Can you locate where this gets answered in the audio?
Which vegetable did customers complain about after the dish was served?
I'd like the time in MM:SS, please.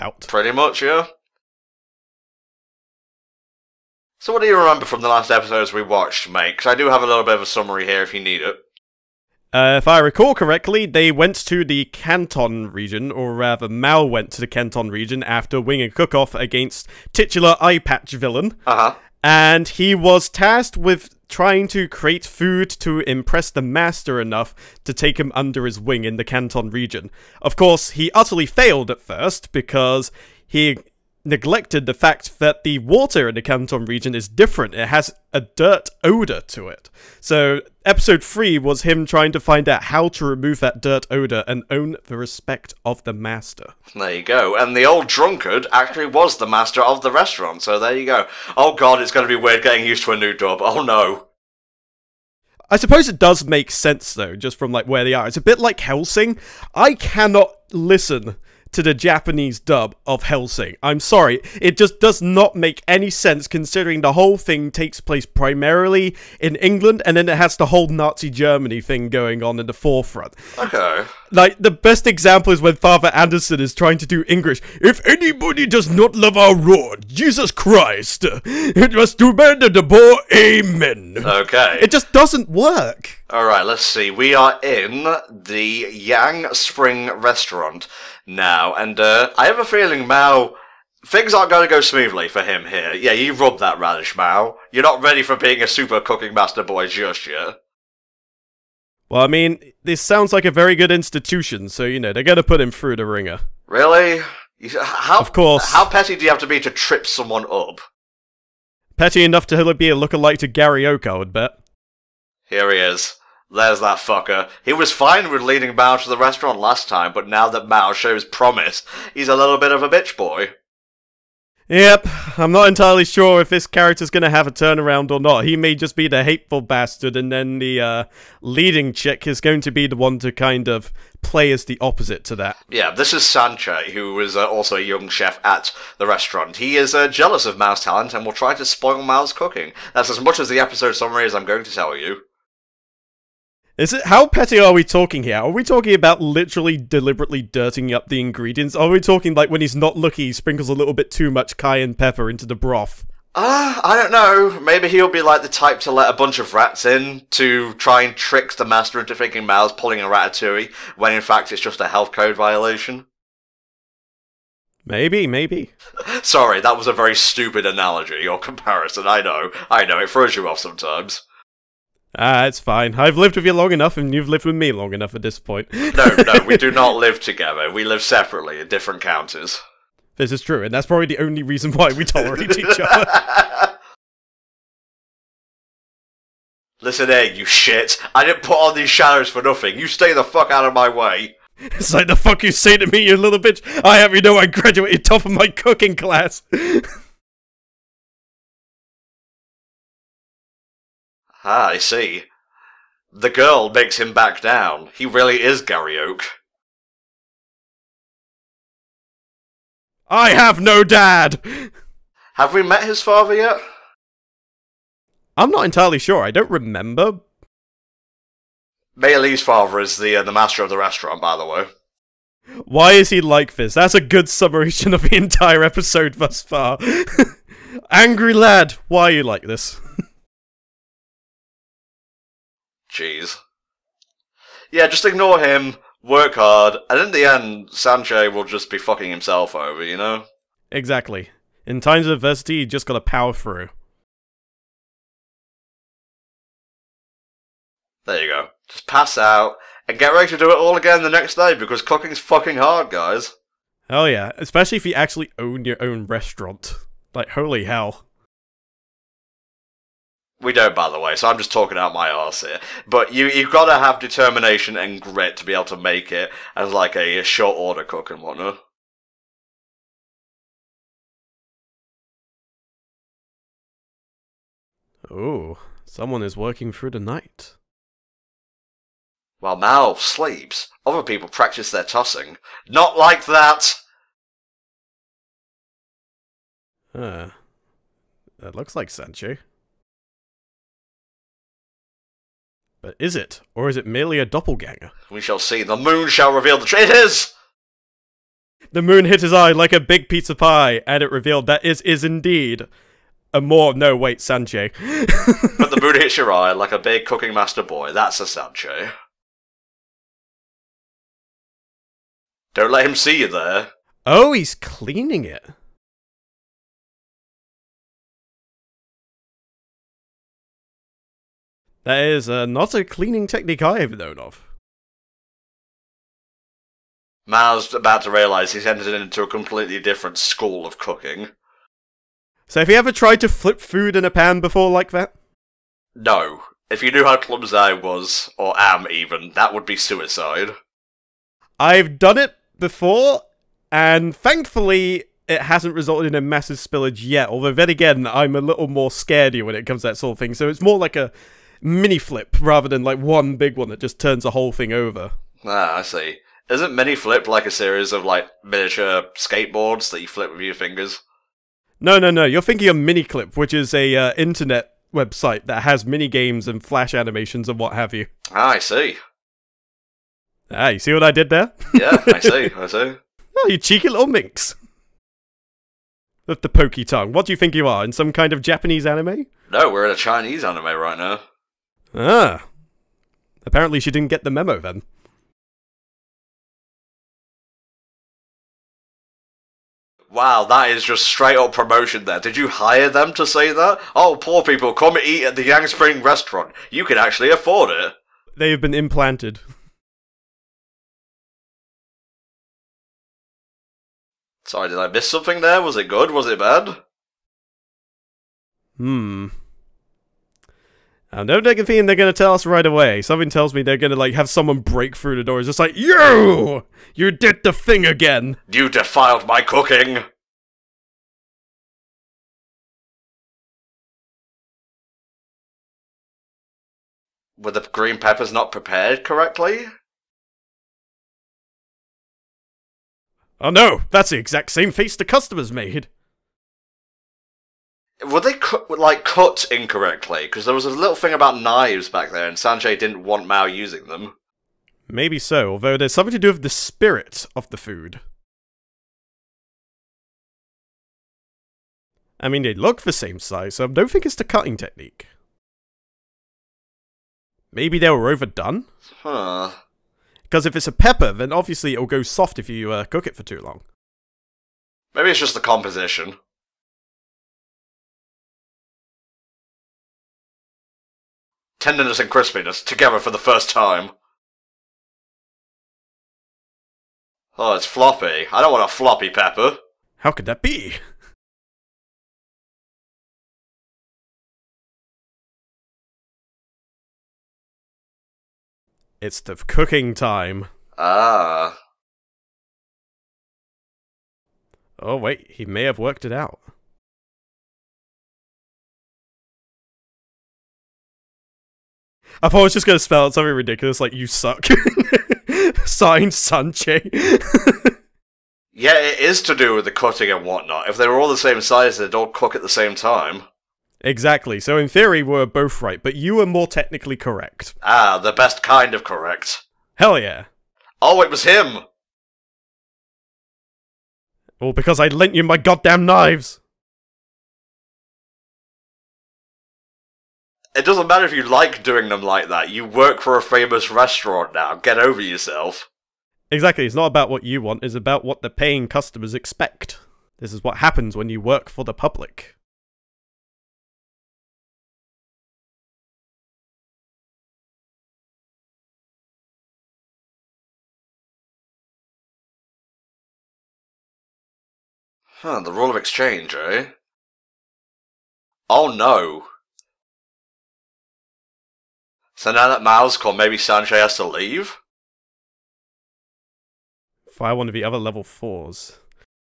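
07:07.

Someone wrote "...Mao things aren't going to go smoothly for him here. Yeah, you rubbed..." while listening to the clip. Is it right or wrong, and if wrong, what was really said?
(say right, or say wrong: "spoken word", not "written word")
right.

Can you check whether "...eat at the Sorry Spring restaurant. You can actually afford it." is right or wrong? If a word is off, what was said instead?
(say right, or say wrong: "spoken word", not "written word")
wrong: "Yang", not "Sorry".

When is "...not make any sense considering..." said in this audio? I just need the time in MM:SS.
01:02.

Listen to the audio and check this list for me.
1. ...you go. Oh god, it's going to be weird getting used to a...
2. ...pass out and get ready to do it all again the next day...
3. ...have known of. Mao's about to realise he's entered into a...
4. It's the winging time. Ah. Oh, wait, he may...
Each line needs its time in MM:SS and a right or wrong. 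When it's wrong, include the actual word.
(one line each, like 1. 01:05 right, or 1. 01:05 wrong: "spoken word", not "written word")
1. 00:47 right
2. 04:08 right
3. 05:23 right
4. 08:08 wrong: "cooking", not "winging".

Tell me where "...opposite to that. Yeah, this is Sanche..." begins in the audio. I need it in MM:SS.
02:11.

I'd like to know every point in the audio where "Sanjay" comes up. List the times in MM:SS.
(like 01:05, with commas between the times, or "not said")
07:22, 09:23.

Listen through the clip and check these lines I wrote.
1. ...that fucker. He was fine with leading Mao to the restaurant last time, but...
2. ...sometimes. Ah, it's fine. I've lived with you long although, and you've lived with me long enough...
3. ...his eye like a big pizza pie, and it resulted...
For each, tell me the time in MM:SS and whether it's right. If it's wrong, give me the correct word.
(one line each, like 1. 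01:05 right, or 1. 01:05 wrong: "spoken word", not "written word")
1. 01:53 right
2. 02:50 wrong: "enough", not "although"
3. 04:59 wrong: "revealed", not "resulted".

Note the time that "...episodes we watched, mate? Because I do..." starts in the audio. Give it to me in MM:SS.
00:05.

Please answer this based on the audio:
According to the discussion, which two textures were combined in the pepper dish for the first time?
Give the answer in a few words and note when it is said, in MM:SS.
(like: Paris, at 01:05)
Tenderness and crispiness, at 07:51.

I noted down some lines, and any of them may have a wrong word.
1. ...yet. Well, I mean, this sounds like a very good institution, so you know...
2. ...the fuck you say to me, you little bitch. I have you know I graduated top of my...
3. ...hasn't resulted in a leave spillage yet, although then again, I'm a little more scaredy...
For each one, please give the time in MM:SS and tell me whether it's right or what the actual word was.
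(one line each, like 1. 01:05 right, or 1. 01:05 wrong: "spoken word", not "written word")
1. 01:37 right
2. 03:12 right
3. 05:45 wrong: "massive", not "leave".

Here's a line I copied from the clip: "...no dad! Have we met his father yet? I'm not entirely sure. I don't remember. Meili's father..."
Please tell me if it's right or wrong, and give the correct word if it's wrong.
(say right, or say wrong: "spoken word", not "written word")
right.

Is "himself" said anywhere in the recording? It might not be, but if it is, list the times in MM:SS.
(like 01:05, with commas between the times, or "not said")
03:59.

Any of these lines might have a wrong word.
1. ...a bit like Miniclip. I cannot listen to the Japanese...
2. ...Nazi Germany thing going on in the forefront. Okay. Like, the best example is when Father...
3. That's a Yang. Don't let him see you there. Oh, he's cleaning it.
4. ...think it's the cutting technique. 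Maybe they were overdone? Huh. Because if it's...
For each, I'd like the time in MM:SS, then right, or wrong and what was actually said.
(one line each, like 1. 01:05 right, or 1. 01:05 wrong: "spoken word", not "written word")
1. 00:55 wrong: "Hellsing", not "Miniclip"
2. 01:07 right
3. 05:07 wrong: "Sancho", not "Yang"
4. 07:33 right.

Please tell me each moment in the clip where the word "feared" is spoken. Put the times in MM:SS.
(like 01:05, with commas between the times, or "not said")
not said.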